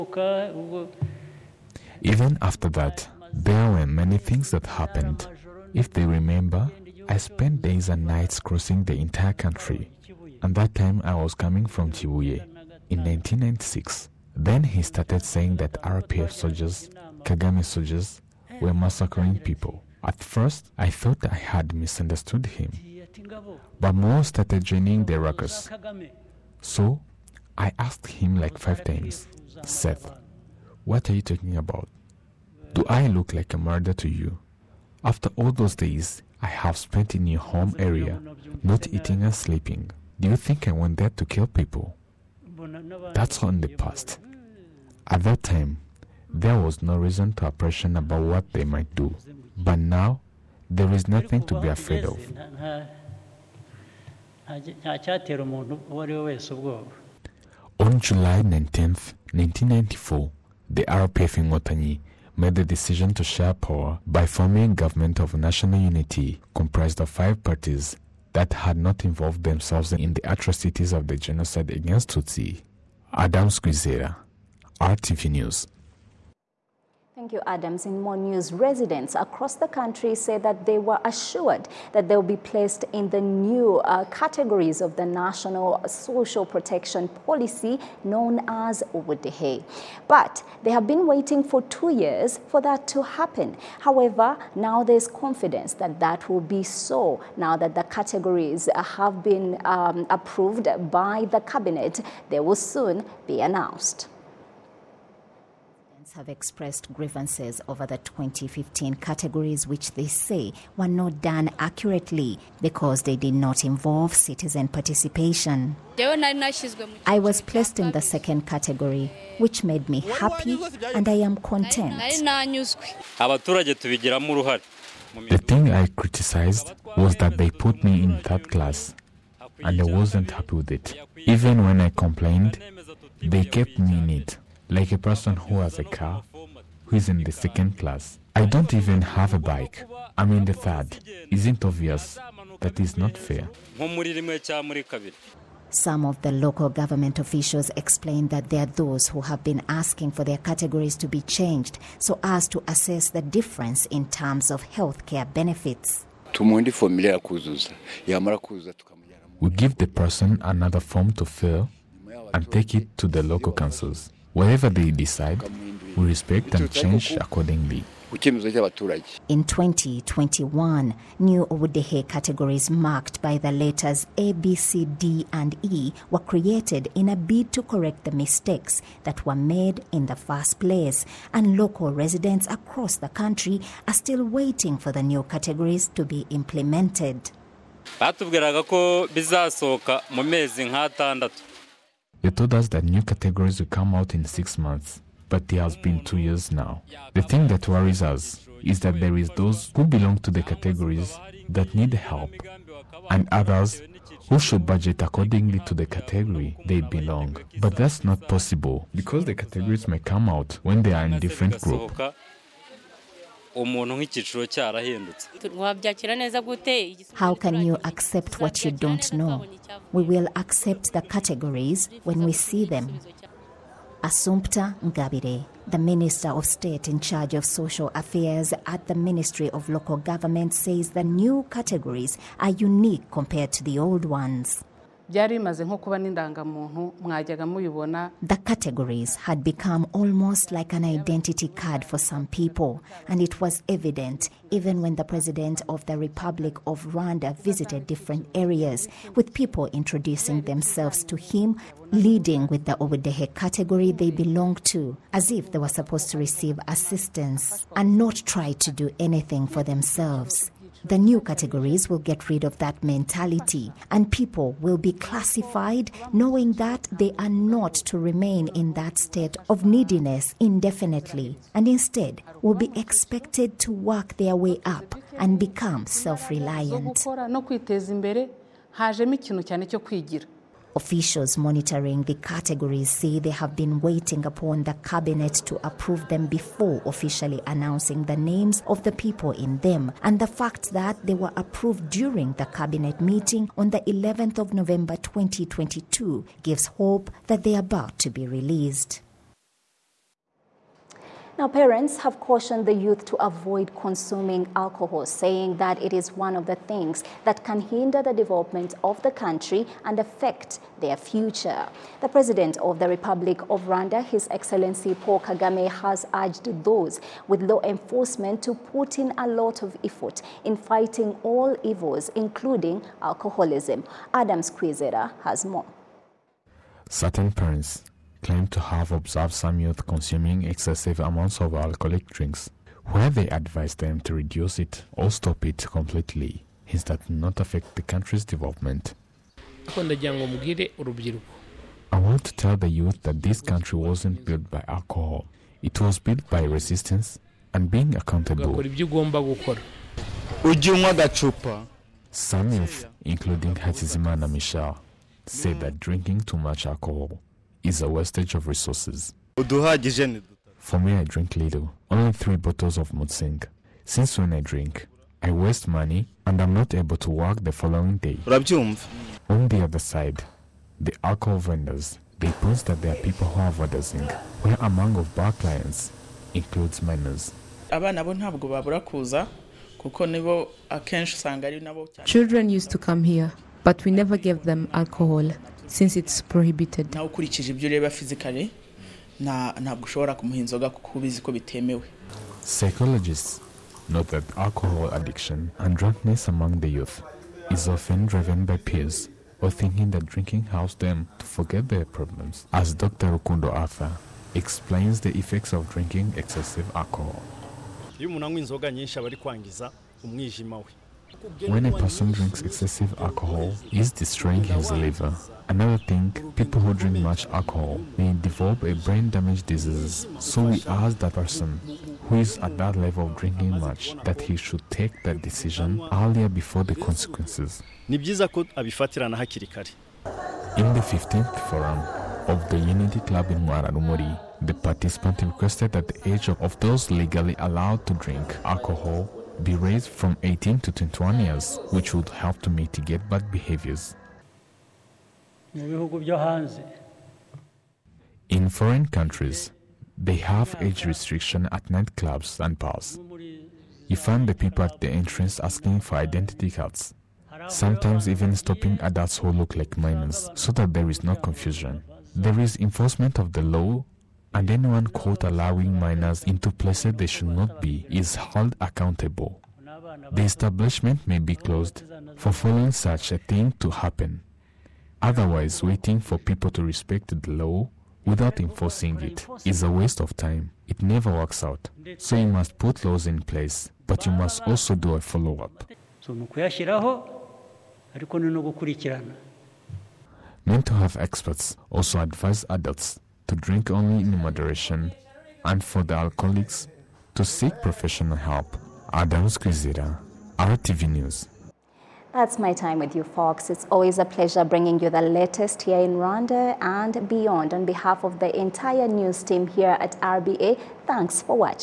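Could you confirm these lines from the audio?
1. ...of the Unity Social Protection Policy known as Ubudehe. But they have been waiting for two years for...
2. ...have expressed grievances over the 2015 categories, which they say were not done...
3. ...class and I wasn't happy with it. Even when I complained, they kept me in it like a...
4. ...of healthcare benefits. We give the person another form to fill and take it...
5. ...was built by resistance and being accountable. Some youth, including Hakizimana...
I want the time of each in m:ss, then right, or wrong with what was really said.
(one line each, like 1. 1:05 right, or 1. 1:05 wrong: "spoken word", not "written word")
1. 1:24 wrong: "National", not "Unity"
2. 1:46 right
3. 2:08 right
4. 2:34 right
5. 5:45 right.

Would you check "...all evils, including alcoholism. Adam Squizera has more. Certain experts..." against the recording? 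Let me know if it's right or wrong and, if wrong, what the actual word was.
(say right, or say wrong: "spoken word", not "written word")
wrong: "parents", not "experts".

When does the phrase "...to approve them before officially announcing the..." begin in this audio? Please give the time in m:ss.
4:45.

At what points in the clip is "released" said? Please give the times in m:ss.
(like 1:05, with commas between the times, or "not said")
4:58.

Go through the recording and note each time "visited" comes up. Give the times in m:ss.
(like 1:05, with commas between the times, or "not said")
4:07.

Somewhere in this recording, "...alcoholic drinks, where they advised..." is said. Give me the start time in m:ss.
5:31.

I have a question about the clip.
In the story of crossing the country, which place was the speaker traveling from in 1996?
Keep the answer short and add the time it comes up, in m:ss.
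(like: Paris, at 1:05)
Kibuye, at 0:11.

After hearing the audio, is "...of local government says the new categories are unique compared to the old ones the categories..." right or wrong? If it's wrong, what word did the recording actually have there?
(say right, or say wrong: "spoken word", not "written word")
right.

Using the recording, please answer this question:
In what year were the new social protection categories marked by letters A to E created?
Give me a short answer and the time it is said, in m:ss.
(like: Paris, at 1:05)
2021, at 2:49.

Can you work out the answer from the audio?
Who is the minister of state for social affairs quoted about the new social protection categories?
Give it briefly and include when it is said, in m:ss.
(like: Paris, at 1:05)
Assumpta Ingabire, at 3:44.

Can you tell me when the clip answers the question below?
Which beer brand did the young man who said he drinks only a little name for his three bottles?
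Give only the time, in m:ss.
6:02.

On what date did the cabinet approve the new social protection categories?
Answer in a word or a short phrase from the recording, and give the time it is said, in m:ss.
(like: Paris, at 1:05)
11 November 2022, at 4:53.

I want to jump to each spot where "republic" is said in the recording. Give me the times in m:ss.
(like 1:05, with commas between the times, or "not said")
4:05, 5:12.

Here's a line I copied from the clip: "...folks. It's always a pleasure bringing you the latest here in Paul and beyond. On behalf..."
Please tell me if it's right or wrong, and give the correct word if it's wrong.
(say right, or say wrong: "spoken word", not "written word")
wrong: "Rwanda", not "Paul".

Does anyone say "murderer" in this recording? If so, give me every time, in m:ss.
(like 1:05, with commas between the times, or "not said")
0:33.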